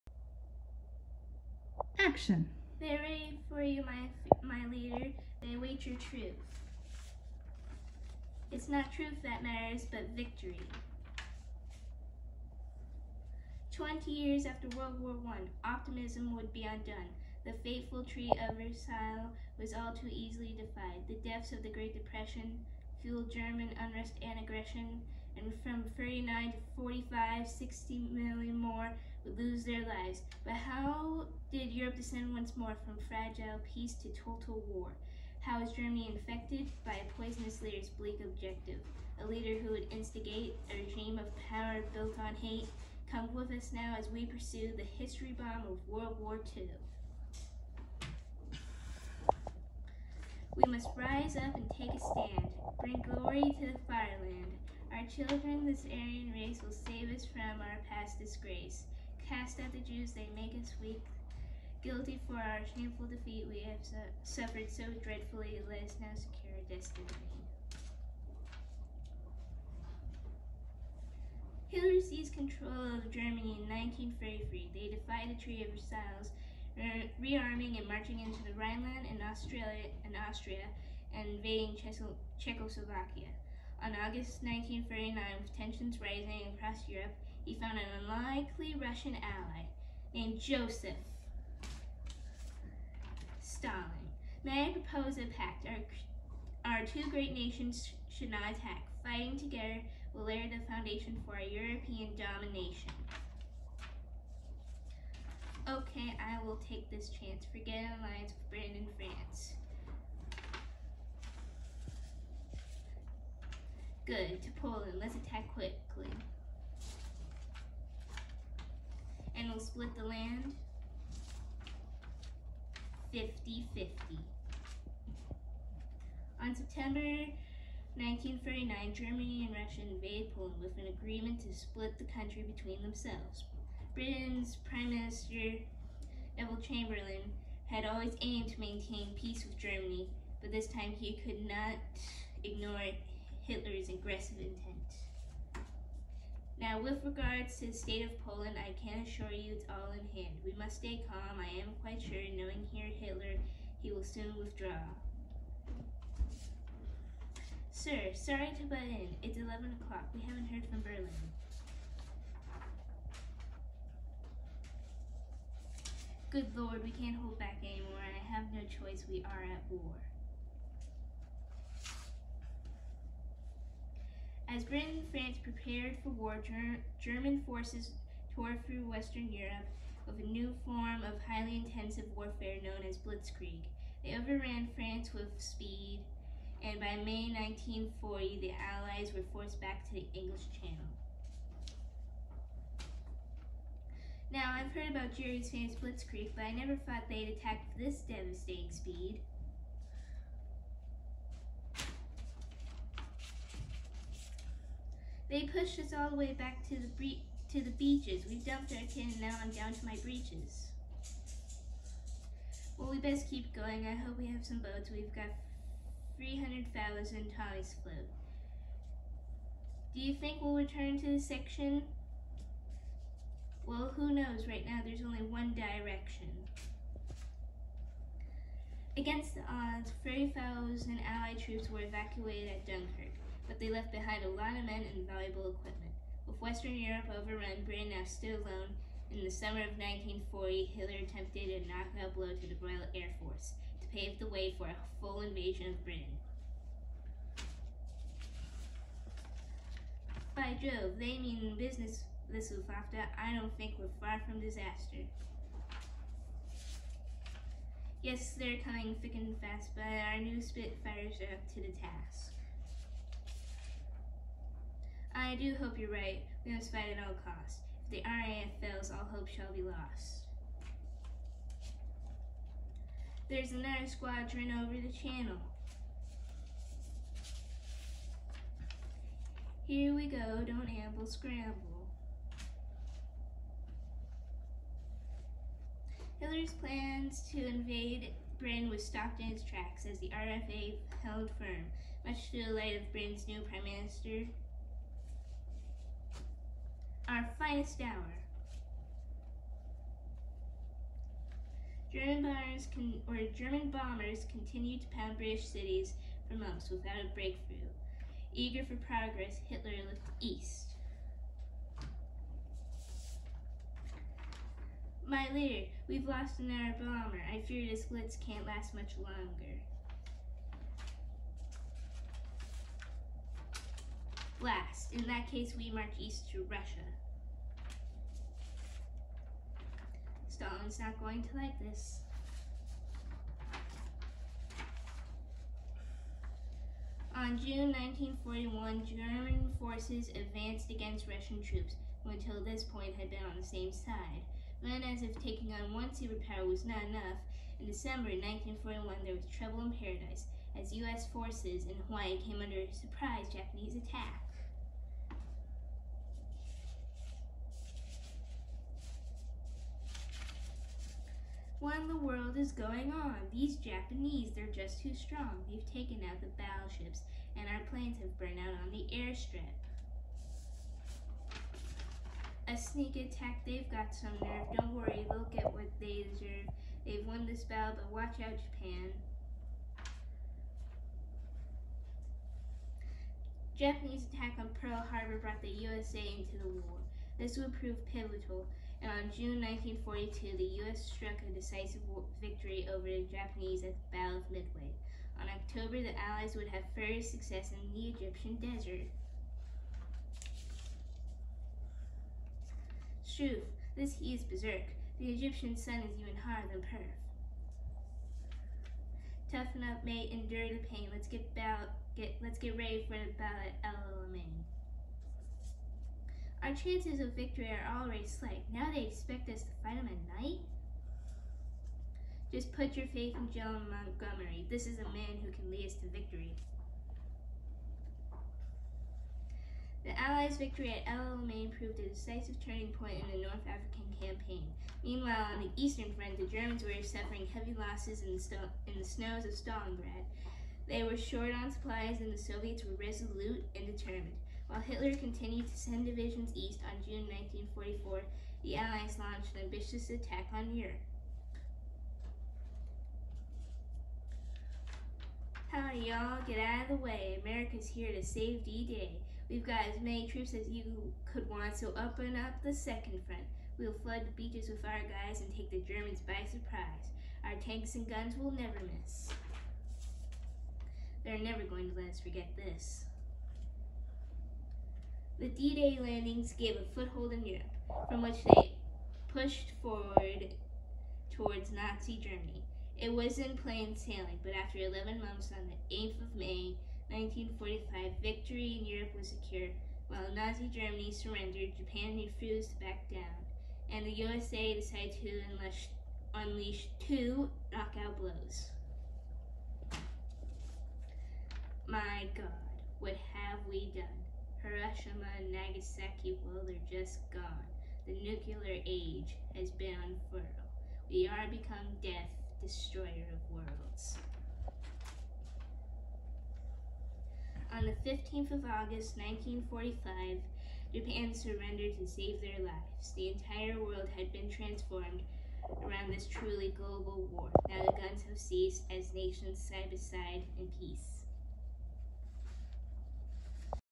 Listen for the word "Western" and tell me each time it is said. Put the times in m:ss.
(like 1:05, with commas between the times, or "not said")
2:58, 3:56.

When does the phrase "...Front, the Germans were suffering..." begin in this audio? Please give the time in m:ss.
7:15.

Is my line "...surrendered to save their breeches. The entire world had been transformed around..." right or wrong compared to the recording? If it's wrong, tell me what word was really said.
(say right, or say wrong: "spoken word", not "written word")
wrong: "lives", not "breeches".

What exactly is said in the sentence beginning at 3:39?
Do you think we'll return to the section?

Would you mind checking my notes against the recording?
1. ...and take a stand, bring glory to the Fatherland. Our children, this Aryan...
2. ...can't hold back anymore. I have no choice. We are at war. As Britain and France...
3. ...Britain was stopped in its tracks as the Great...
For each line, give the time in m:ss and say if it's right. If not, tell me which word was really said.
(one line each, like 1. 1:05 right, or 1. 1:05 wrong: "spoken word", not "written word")
1. 0:51 right
2. 2:46 right
3. 4:48 wrong: "RFA", not "Great".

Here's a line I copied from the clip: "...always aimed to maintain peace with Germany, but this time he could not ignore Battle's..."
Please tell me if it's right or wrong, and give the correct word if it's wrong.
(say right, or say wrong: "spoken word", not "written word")
wrong: "Hitler", not "Battle".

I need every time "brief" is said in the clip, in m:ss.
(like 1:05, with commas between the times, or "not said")
not said.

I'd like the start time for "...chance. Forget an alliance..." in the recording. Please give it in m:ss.
1:47.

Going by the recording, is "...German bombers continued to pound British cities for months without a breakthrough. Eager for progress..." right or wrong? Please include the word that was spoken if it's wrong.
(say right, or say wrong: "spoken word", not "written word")
right.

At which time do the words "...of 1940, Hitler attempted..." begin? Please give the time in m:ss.
3:59.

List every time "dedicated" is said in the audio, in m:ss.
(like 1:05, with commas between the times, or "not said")
not said.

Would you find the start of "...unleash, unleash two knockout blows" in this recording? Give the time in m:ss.
8:15.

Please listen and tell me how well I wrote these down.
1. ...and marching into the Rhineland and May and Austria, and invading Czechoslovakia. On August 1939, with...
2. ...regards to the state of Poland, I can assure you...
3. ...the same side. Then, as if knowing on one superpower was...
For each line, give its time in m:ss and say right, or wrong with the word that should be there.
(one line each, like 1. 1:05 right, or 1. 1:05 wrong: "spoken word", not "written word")
1. 1:17 wrong: "Australia", not "May"
2. 2:27 right
3. 5:43 wrong: "taking", not "knowing".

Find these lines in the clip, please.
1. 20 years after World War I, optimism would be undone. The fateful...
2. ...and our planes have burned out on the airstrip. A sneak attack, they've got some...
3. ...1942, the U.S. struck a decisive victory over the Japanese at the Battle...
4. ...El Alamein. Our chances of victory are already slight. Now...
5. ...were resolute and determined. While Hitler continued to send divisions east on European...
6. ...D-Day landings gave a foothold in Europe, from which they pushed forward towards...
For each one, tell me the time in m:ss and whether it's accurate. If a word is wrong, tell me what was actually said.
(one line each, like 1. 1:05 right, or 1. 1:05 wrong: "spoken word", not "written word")
1. 0:13 right
2. 6:07 right
3. 6:29 right
4. 6:53 right
5. 7:22 wrong: "June", not "European"
6. 7:55 right.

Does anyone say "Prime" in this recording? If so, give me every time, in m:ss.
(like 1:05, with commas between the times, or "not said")
2:14, 4:53.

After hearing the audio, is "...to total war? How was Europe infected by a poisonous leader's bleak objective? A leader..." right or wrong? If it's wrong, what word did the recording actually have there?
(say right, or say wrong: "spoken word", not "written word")
wrong: "Germany", not "Europe".